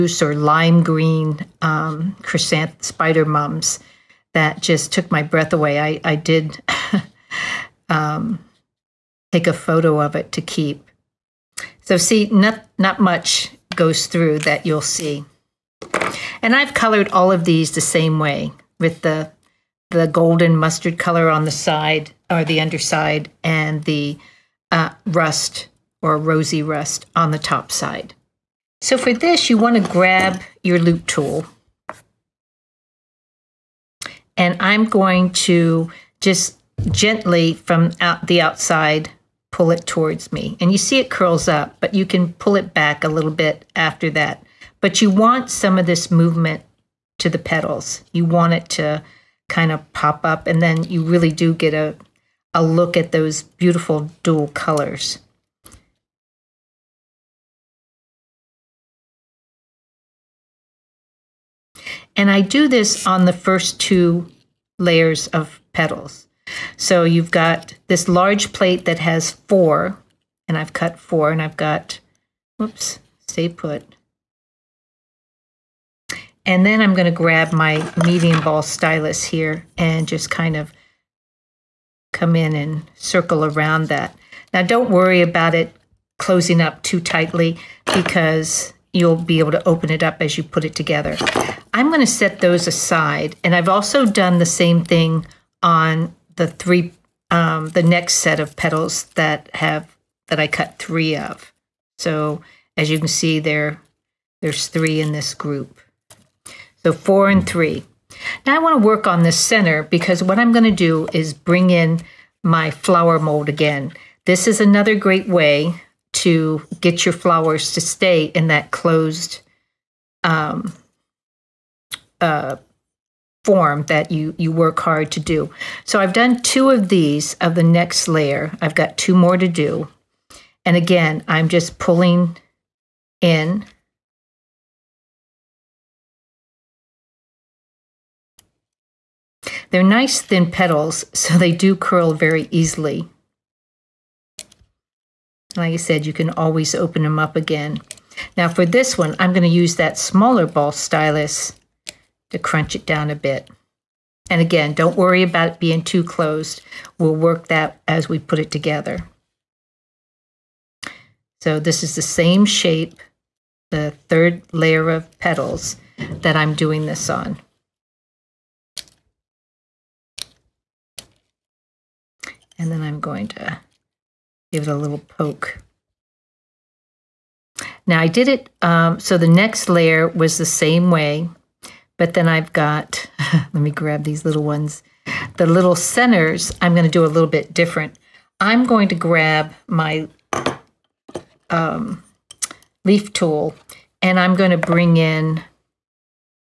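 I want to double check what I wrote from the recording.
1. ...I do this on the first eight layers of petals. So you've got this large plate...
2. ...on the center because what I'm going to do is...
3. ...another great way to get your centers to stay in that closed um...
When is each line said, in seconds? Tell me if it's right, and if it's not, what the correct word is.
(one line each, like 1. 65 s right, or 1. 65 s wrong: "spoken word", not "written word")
1. 62 s wrong: "two", not "eight"
2. 109 s right
3. 114 s wrong: "flowers", not "centers".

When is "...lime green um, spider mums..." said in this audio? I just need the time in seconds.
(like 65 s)
0 s.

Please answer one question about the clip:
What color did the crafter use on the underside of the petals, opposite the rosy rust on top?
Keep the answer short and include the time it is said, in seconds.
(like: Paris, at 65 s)
golden mustard, at 20 s.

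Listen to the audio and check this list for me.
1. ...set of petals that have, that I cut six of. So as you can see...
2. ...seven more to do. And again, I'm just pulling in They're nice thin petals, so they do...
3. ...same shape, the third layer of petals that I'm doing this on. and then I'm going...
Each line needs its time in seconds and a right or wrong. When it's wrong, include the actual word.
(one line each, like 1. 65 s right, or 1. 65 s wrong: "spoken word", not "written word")
1. 98 s wrong: "three", not "six"
2. 128 s wrong: "two", not "seven"
3. 162 s right.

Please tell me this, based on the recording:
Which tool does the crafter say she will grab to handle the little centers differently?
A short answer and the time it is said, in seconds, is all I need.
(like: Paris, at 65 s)
leaf tool, at 192 s.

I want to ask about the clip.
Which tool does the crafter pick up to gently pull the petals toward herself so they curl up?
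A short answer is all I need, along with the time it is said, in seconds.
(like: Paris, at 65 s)
loop tool, at 30 s.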